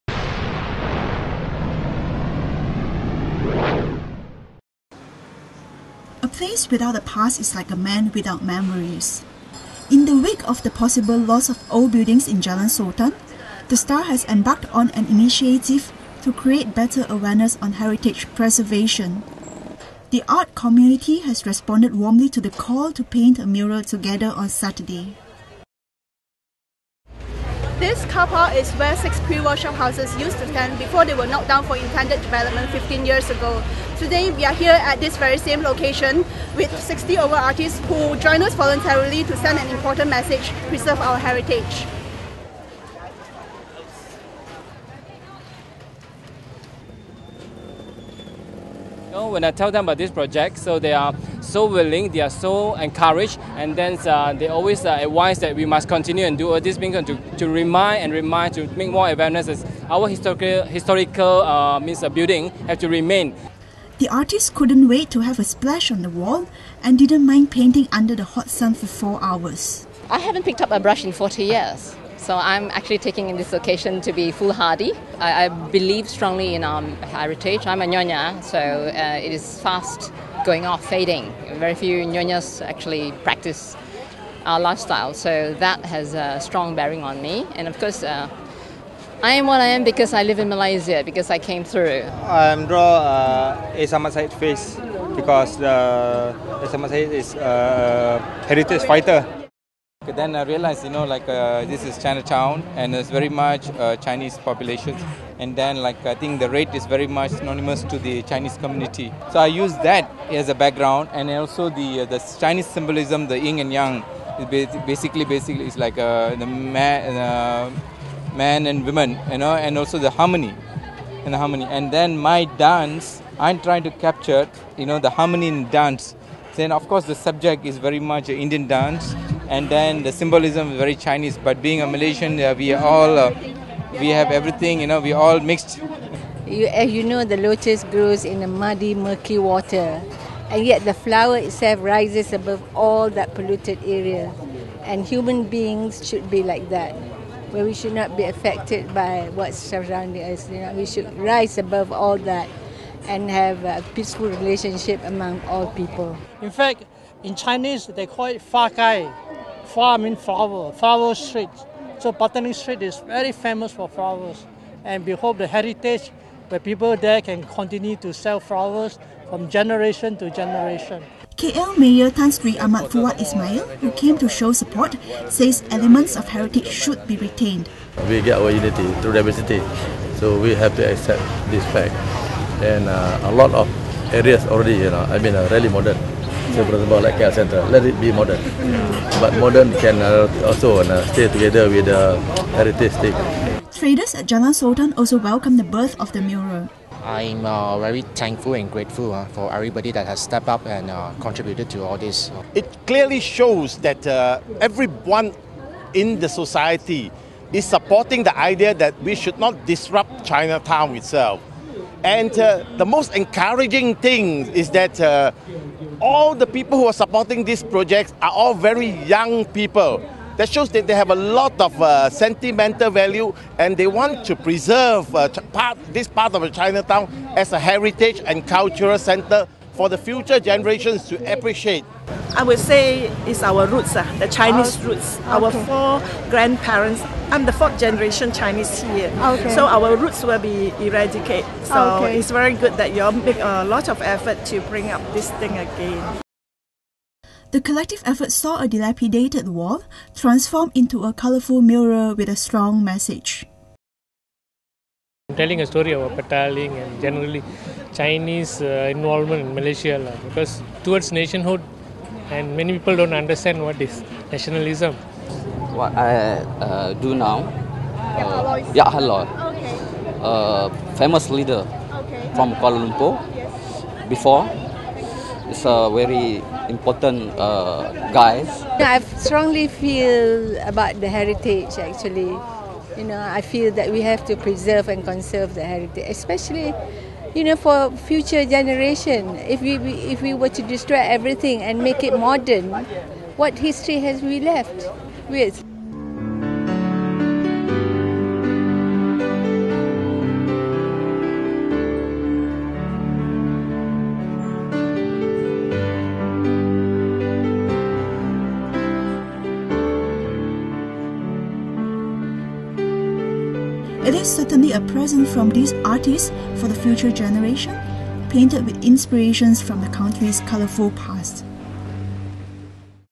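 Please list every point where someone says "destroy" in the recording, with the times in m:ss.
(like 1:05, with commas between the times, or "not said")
4:50.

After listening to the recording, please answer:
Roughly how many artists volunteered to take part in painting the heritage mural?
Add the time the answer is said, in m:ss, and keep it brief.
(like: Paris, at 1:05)
60, at 0:36.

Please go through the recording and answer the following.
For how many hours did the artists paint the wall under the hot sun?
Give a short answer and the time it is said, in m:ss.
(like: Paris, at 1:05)
4, at 1:08.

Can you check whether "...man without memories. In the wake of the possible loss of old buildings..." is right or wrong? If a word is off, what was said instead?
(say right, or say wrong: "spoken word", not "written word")
right.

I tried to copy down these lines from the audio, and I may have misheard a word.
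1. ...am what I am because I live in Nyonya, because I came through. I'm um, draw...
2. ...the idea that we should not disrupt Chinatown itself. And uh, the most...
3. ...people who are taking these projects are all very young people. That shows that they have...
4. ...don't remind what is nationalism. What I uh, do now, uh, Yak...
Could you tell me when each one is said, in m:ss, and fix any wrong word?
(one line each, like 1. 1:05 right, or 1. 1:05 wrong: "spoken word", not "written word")
1. 1:29 wrong: "Malaysia", not "Nyonya"
2. 3:28 right
3. 3:36 wrong: "supporting", not "taking"
4. 4:22 wrong: "understand", not "remind".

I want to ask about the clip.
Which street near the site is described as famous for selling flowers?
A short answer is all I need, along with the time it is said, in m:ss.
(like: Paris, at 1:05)
Botany Street, at 2:42.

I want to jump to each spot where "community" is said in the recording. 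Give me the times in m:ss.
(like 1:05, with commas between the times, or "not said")
0:20, 1:48.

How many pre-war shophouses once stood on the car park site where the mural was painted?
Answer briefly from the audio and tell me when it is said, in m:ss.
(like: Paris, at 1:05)
6, at 0:28.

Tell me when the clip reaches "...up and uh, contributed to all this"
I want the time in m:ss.
3:20.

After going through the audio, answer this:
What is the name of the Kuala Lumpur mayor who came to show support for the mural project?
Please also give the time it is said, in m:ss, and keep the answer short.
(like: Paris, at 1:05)
Tan Sri Ahmad Fuad Ismail, at 2:52.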